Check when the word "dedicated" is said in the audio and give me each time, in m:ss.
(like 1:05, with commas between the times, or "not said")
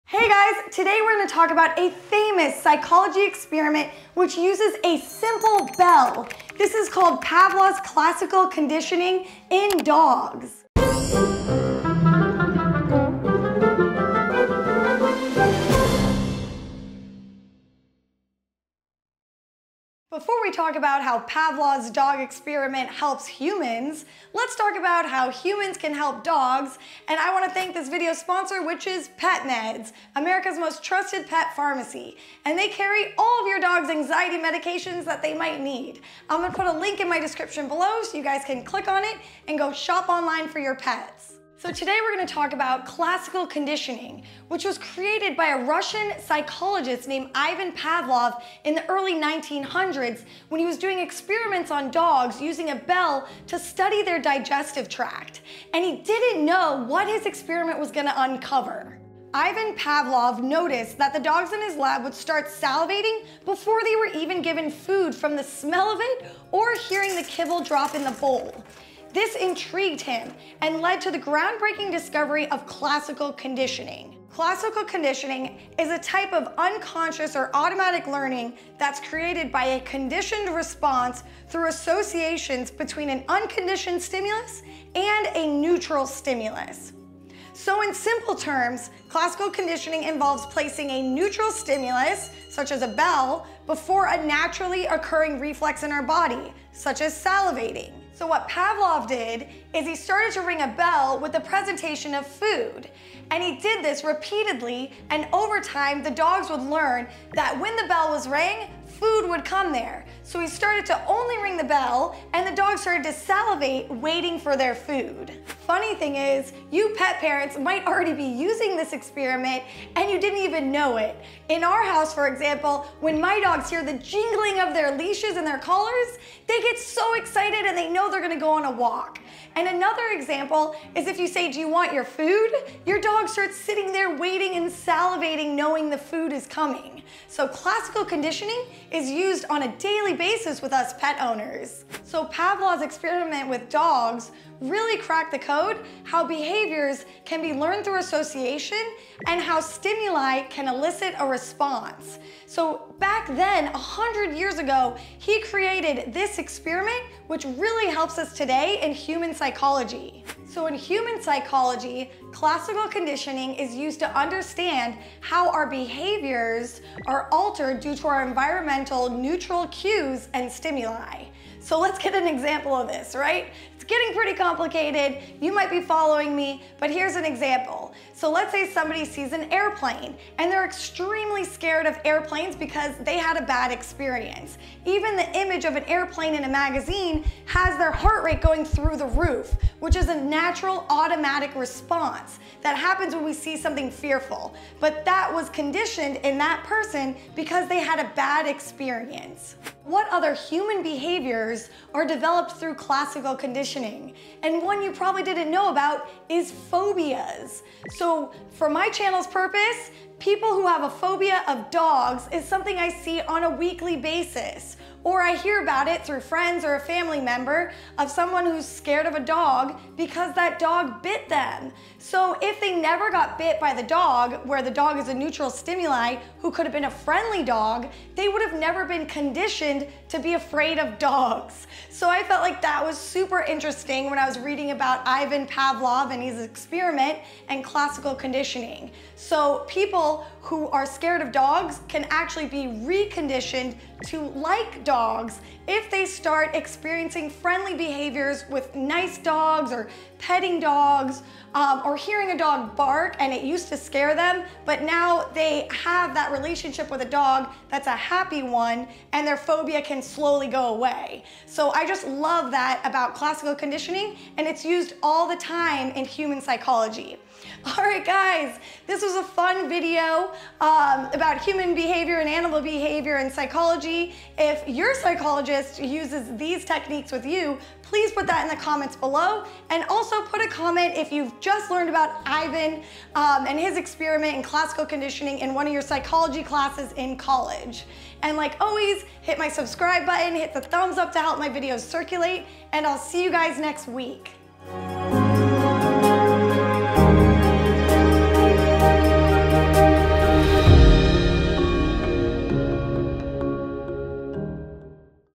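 not said.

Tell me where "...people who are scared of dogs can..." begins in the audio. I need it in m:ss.
3:59.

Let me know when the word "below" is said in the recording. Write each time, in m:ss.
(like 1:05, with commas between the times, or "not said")
0:37, 4:38.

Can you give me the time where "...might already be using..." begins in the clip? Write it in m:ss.
1:57.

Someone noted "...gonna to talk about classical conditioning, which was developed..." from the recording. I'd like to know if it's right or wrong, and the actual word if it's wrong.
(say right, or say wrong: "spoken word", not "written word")
wrong: "created", not "developed".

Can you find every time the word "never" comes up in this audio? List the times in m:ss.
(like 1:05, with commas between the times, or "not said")
3:42, 3:48.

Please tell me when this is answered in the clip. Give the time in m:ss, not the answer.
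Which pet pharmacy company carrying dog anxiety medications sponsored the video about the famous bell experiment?
0:29.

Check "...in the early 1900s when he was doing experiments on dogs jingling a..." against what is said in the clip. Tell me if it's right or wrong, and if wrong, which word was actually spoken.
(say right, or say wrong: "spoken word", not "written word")
wrong: "using", not "jingling".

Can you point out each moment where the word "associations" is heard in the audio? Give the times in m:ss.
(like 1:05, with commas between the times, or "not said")
1:21, 2:27.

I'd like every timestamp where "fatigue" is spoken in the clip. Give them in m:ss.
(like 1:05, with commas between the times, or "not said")
not said.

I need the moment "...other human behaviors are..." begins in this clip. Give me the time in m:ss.
3:20.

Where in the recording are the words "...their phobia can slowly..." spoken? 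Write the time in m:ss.
4:19.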